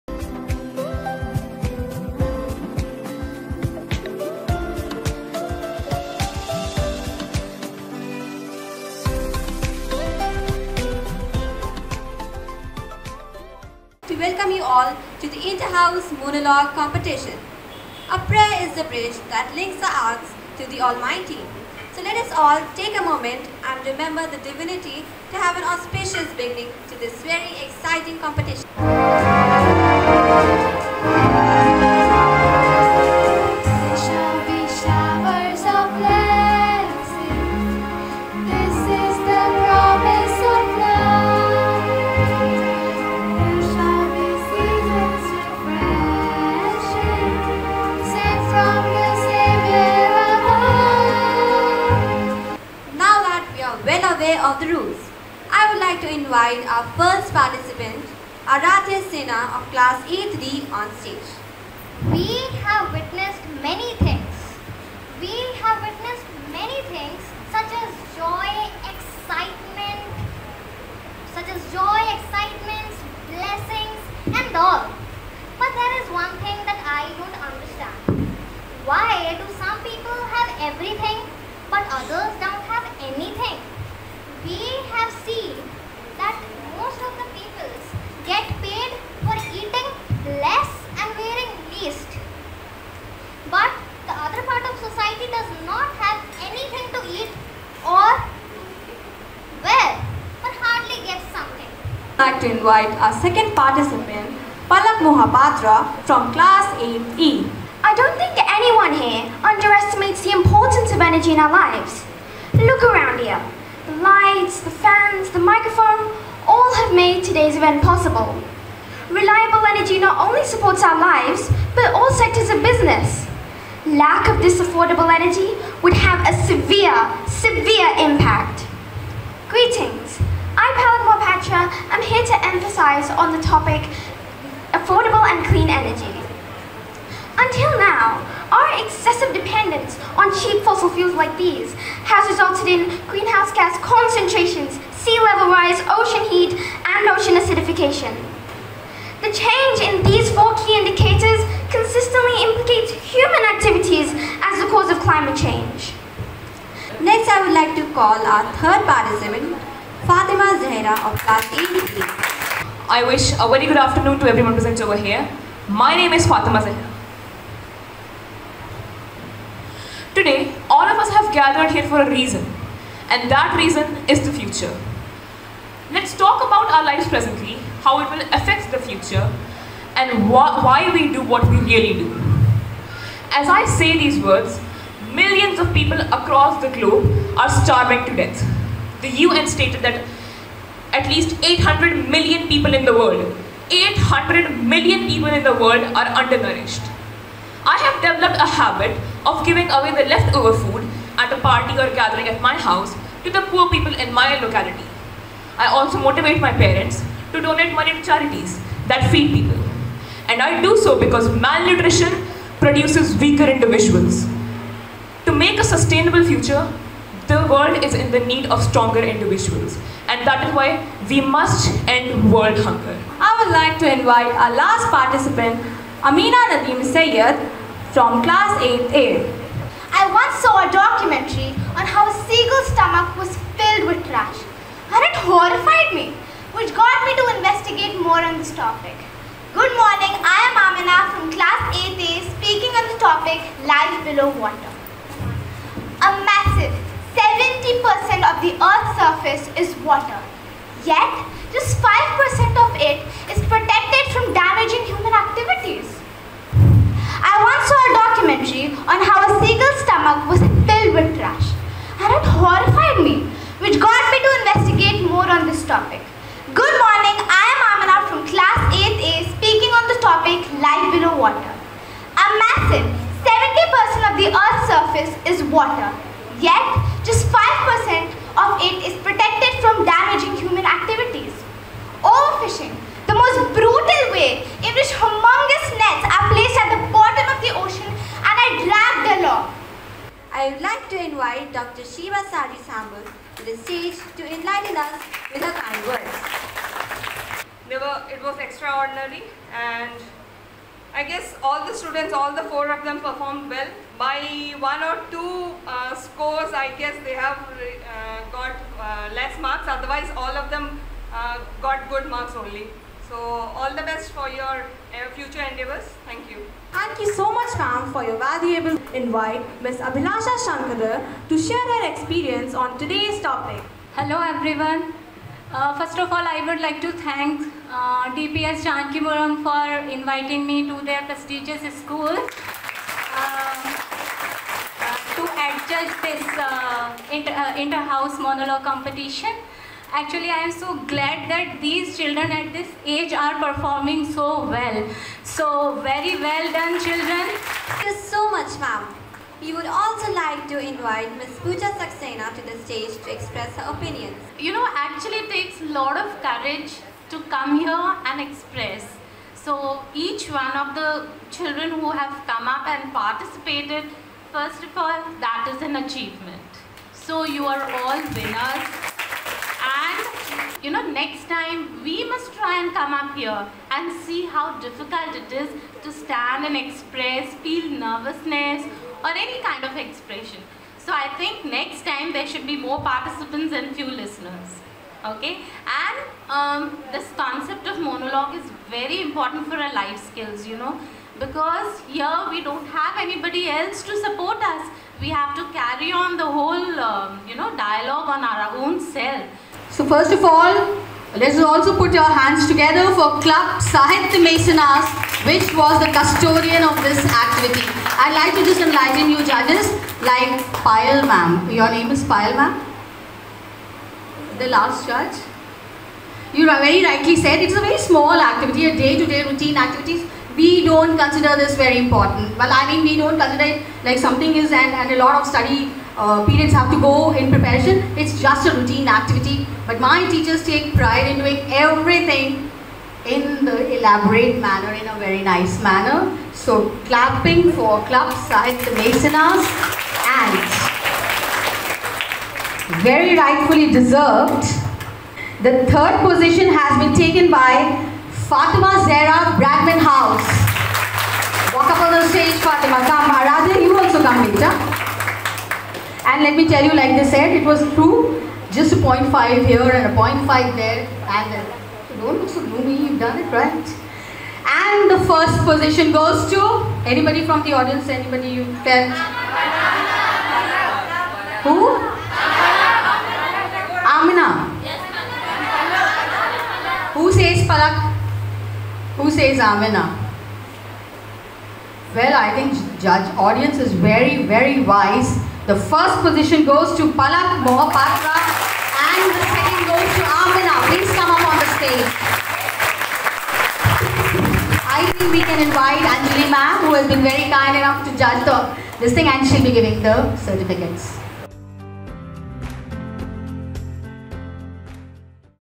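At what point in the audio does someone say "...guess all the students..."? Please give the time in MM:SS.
05:01.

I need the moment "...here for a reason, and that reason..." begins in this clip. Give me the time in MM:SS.
02:51.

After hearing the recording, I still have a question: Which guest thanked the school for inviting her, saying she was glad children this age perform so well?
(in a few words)
Abhilasha Shankara.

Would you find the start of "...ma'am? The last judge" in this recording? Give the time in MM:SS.
06:52.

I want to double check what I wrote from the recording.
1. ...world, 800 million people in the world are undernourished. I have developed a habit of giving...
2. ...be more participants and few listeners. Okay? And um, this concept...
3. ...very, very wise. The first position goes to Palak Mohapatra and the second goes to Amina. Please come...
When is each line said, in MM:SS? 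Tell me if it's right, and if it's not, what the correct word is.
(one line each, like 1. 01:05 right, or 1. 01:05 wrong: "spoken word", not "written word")
1. 03:12 right
2. 06:22 right
3. 08:03 right.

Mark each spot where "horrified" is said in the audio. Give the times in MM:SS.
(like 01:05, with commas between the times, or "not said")
03:55, 04:22.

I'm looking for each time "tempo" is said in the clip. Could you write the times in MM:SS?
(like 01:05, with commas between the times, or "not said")
not said.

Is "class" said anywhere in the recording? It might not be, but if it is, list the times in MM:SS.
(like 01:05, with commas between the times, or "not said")
00:59, 01:46, 02:41, 03:48, 04:01, 04:28.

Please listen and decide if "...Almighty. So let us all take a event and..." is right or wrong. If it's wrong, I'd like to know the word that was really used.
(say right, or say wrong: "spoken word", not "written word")
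wrong: "moment", not "event".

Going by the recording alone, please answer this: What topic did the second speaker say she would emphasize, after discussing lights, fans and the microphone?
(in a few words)
Affordable and clean energy.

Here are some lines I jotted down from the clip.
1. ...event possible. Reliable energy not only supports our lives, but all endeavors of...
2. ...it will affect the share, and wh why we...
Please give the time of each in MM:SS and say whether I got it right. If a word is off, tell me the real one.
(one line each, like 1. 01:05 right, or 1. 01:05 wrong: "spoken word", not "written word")
1. 01:57 wrong: "sectors", not "endeavors"
2. 02:58 wrong: "future", not "share".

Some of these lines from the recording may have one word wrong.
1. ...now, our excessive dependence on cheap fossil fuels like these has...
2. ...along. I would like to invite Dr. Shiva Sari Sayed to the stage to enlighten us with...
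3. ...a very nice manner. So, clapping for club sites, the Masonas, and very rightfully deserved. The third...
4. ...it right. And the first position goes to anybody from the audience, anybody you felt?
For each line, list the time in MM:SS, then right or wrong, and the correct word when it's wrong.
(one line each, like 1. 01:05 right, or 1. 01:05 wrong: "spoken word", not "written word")
1. 02:17 right
2. 04:49 wrong: "Sambal", not "Sayed"
3. 07:14 right
4. 07:43 right.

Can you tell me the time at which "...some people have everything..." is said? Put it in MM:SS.
01:19.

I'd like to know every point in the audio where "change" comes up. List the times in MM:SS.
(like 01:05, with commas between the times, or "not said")
02:29, 02:35.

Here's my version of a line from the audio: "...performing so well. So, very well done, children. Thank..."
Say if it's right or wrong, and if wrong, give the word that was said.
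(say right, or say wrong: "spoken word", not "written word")
right.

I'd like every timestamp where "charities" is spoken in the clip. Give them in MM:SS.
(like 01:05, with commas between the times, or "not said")
03:28.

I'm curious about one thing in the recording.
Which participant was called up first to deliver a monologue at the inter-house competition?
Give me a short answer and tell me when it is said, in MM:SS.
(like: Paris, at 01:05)
Aradhya Sena, at 00:58.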